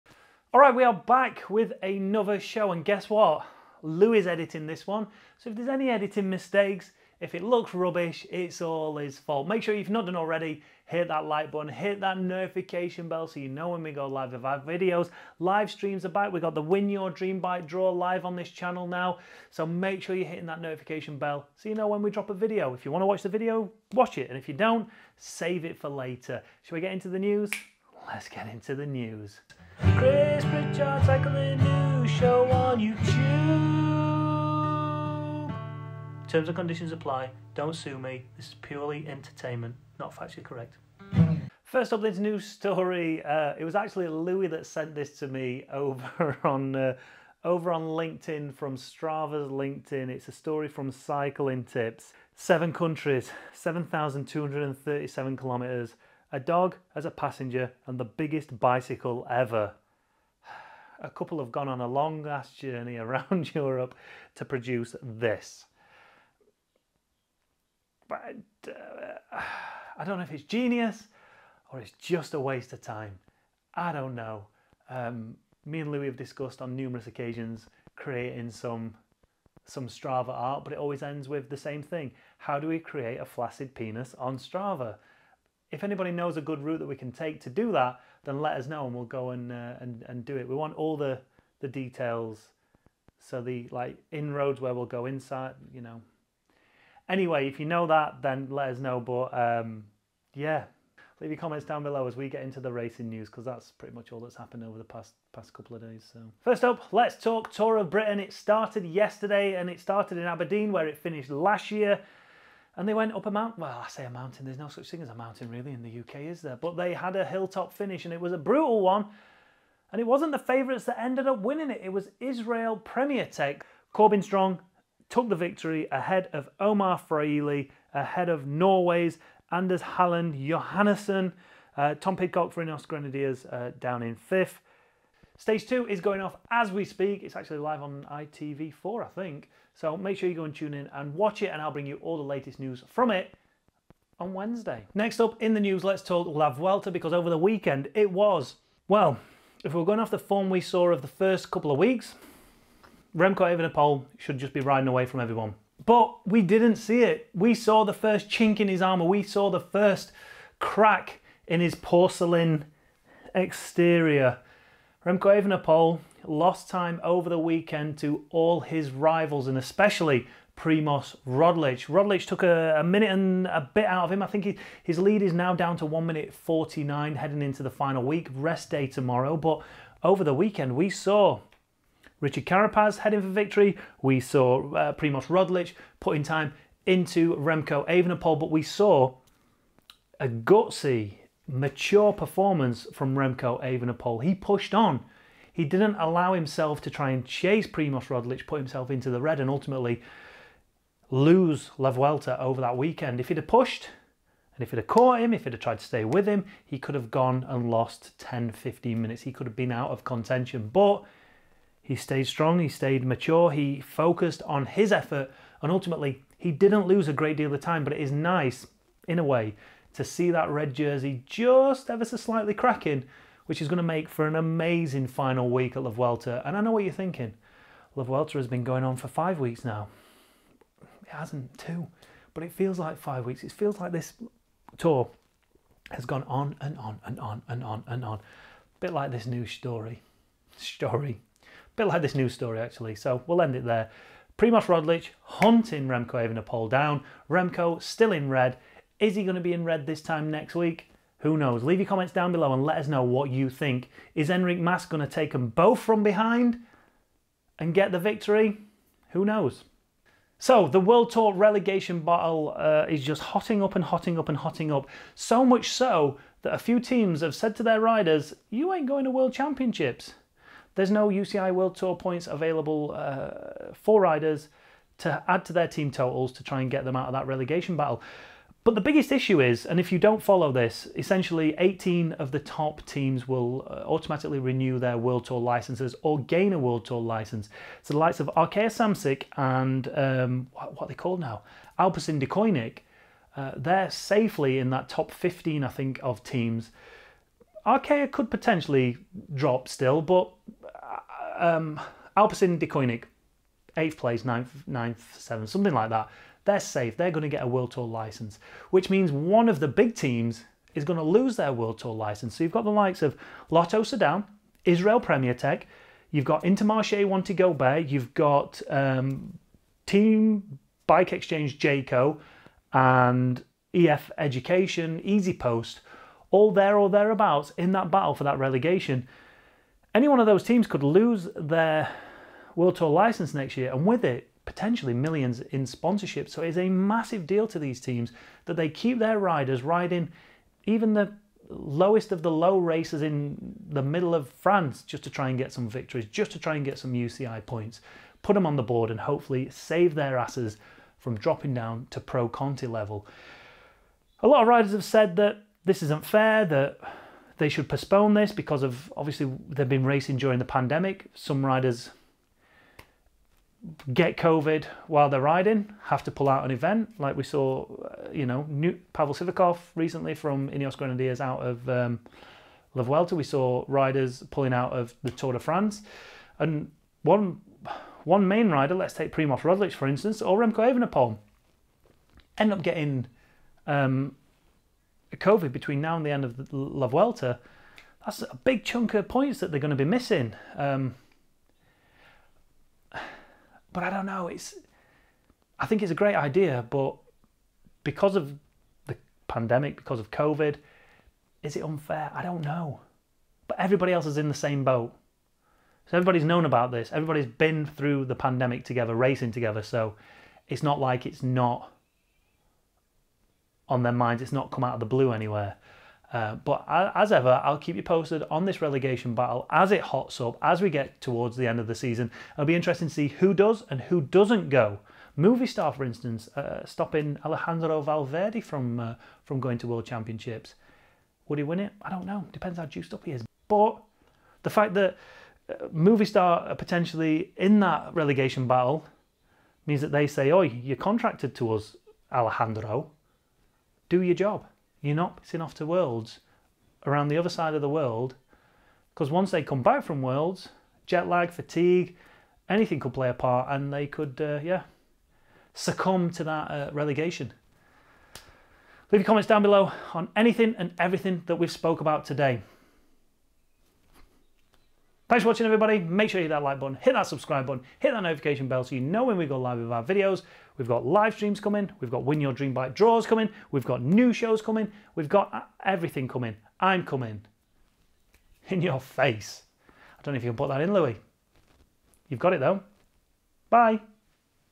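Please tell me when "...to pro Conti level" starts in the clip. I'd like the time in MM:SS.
05:51.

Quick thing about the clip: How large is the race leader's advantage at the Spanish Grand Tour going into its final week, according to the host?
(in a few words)
1 minute 49.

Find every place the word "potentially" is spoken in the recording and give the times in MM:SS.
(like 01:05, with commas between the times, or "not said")
04:58, 05:34, 07:16.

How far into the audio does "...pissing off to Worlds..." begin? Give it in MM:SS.
07:25.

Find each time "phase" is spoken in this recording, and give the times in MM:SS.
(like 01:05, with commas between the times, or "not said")
not said.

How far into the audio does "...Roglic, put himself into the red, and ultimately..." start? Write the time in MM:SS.
03:18.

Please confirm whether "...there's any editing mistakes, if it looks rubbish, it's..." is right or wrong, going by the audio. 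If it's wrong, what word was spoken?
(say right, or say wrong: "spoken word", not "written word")
right.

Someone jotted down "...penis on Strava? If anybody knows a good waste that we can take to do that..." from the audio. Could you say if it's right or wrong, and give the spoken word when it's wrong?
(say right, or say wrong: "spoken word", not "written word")
wrong: "route", not "waste".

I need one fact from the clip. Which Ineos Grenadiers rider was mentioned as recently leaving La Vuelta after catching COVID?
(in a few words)
Pavel Sivakov.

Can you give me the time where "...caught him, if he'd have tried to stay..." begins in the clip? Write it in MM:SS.
03:24.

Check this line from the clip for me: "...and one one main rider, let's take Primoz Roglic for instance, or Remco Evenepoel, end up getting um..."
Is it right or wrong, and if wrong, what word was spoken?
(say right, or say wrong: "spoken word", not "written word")
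right.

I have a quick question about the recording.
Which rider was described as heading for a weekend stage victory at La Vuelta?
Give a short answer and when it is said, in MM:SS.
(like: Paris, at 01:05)
Richard Carapaz, at 03:02.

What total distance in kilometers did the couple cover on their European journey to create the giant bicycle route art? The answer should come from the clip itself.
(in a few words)
7,237 kilometers.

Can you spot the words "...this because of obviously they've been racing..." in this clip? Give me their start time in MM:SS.
05:58.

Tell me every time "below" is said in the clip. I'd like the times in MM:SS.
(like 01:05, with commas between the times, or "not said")
01:41, 04:12, 07:39.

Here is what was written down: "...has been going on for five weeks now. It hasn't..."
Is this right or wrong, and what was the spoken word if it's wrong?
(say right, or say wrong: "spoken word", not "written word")
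right.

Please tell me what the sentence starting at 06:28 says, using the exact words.
That's a big chunk of points that they're going to be missing.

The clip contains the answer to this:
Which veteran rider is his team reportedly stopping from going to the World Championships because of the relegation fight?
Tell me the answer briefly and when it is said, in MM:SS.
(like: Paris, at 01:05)
Alejandro Valverde, at 07:07.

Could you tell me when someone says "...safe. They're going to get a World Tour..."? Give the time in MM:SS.
05:06.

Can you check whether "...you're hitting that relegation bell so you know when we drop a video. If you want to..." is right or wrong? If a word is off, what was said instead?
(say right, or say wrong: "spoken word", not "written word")
wrong: "notification", not "relegation".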